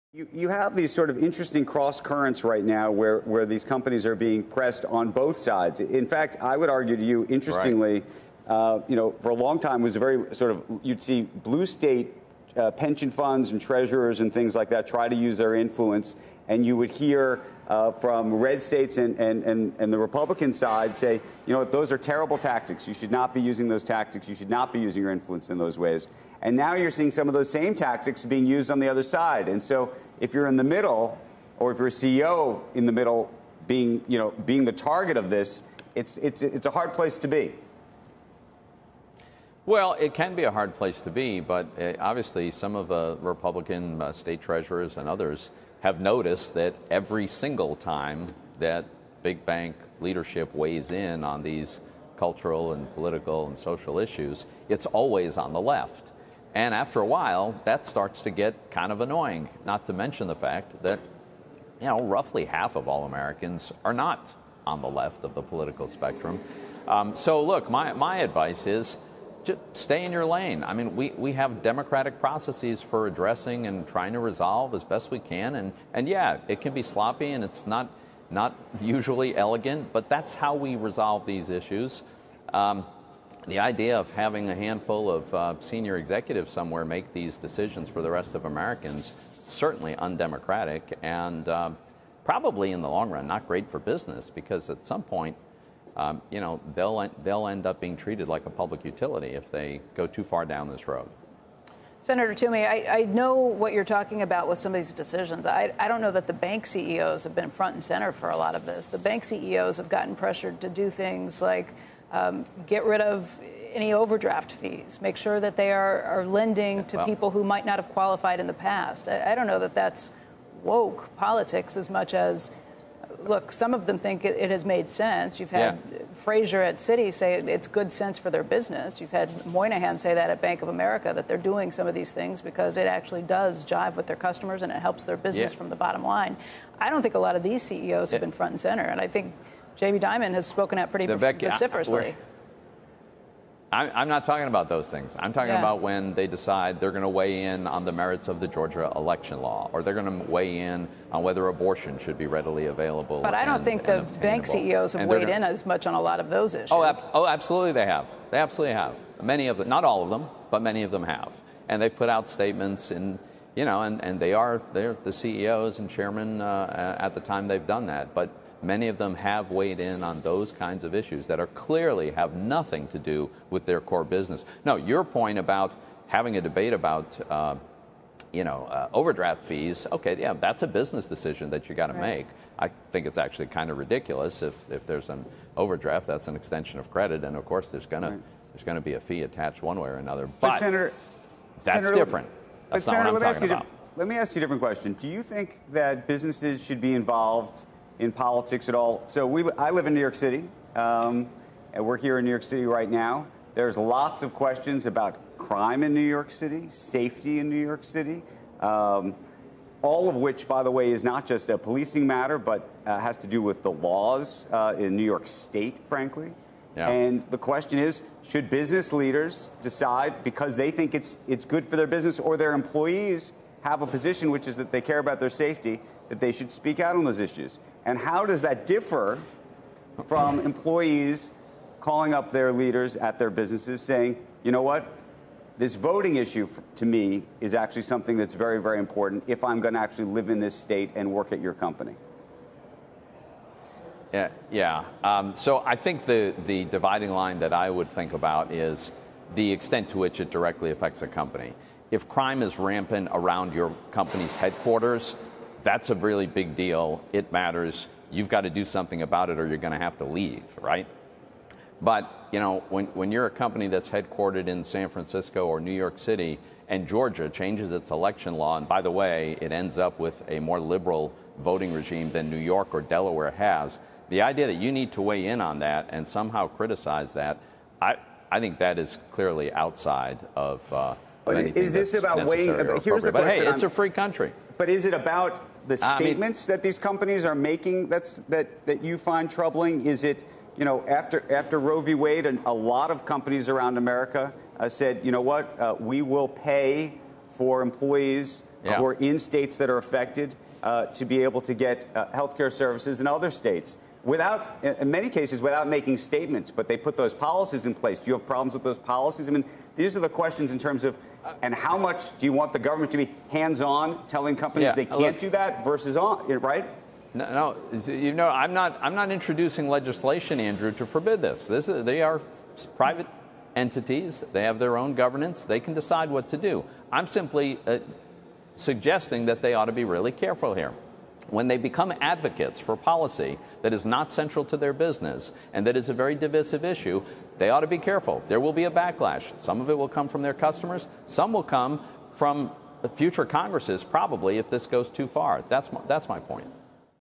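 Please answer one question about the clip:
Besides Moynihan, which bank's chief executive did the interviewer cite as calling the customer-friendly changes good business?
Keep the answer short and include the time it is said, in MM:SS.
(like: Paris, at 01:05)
Citi, at 02:06.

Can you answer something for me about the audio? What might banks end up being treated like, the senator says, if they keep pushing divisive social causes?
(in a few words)
A public utility.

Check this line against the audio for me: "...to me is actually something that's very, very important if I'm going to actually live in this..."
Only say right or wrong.
right.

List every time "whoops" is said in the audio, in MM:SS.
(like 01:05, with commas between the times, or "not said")
not said.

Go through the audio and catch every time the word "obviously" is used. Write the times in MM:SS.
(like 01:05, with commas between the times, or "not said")
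00:41.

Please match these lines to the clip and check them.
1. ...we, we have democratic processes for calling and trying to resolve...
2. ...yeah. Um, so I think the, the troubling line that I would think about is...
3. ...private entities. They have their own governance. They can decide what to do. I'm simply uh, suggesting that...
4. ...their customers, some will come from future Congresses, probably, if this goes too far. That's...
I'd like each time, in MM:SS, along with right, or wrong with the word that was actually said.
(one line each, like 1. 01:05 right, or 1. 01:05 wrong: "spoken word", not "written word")
1. 01:10 wrong: "addressing", not "calling"
2. 04:04 wrong: "dividing", not "troubling"
3. 05:22 right
4. 05:40 right.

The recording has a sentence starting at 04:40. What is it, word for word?
Uh, but is this about weighing?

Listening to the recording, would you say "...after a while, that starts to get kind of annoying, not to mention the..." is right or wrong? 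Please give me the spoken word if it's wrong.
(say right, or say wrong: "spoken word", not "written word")
right.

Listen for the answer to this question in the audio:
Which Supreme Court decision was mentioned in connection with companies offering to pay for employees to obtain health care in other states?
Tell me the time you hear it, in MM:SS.
04:51.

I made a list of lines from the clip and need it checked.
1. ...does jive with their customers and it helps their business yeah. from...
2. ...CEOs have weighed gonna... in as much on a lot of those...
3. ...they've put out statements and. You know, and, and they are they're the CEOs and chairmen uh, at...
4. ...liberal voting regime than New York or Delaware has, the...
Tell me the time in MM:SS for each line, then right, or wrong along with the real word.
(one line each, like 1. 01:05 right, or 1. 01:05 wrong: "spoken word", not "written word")
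1. 02:13 right
2. 02:34 right
3. 02:41 right
4. 04:30 right.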